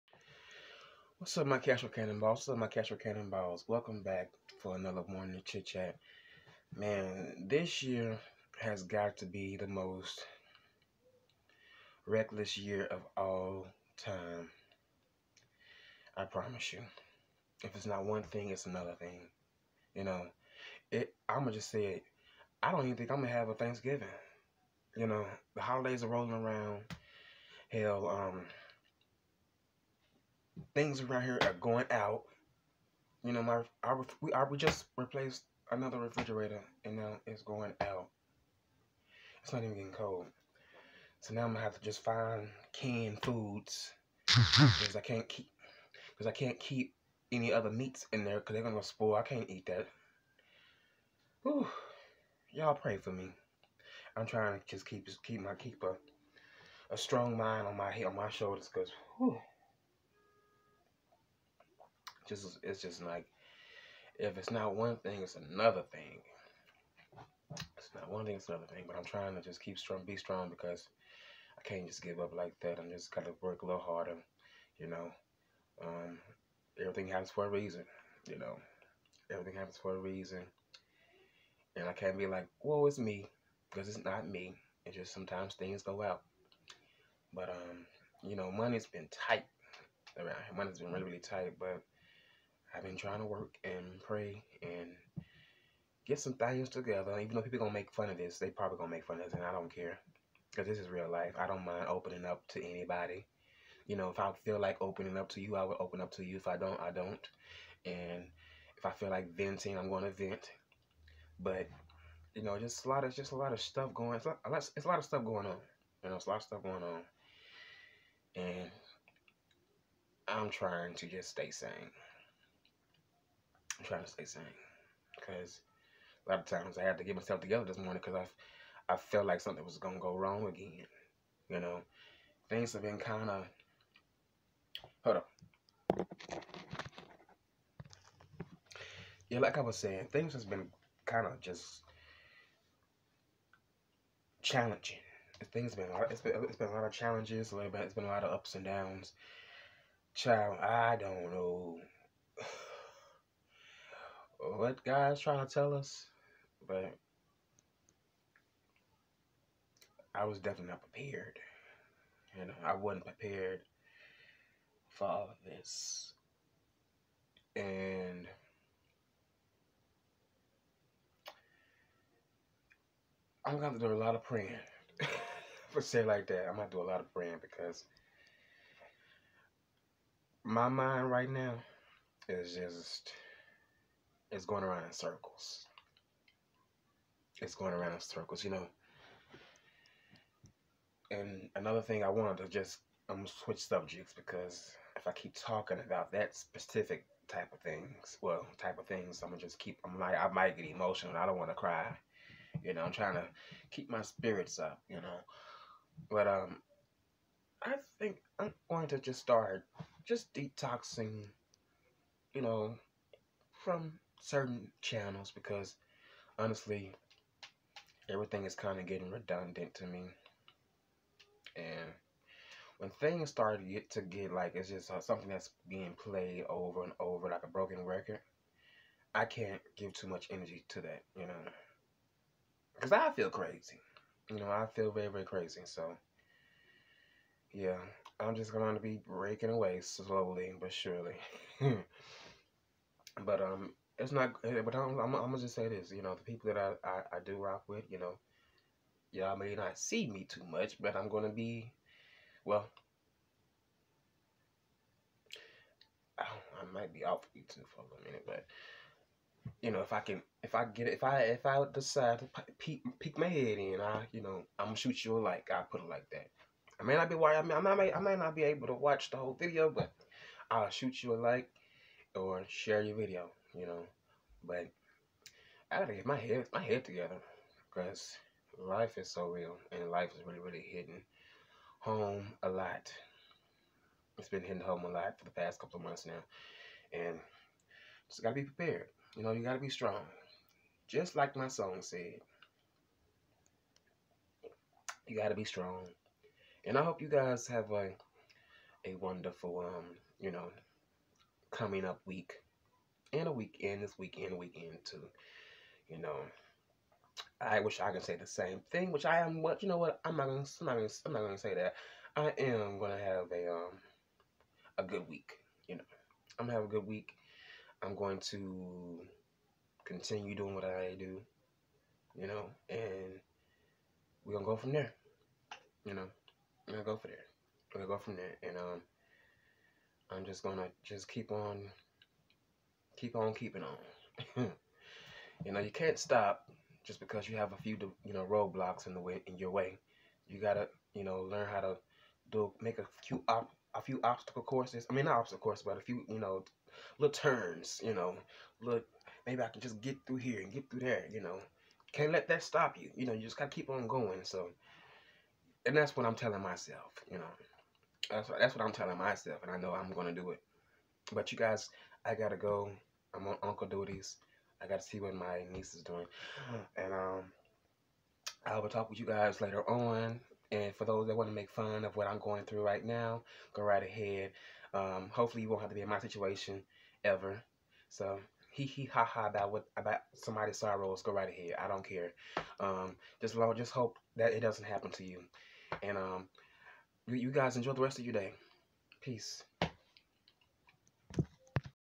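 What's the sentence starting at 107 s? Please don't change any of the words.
And if I feel like venting, I'm going to vent.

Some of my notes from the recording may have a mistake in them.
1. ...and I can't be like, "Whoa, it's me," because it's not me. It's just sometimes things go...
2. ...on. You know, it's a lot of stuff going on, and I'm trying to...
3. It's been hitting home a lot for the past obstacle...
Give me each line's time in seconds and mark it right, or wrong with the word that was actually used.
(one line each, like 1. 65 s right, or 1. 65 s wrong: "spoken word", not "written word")
1. 81 s right
2. 115 s right
3. 284 s wrong: "couple", not "obstacle".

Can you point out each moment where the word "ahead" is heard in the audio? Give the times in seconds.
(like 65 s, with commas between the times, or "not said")
373 s, 381 s.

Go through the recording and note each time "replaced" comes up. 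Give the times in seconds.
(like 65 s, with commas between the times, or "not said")
34 s.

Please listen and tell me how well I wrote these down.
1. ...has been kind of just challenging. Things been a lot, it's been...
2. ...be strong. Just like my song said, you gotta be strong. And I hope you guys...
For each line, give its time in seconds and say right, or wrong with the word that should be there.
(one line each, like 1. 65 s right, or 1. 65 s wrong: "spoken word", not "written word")
1. 140 s right
2. 289 s right.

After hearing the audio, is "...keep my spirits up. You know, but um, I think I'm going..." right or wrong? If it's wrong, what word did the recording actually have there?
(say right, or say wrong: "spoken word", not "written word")
right.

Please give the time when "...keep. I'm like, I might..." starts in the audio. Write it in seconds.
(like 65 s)
199 s.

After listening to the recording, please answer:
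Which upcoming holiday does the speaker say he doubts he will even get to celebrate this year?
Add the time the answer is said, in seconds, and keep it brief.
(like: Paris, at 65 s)
Thanksgiving, at 23 s.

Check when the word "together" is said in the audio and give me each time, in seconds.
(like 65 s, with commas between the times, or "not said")
96 s, 127 s, 276 s.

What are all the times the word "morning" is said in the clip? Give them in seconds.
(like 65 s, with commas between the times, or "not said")
5 s, 127 s.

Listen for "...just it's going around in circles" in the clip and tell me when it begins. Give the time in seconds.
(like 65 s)
182 s.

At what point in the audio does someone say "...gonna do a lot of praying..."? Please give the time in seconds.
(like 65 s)
176 s.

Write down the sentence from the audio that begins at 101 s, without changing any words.
I don't mind opening up to anybody.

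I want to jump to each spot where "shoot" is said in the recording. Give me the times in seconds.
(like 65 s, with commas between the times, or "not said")
264 s, 270 s.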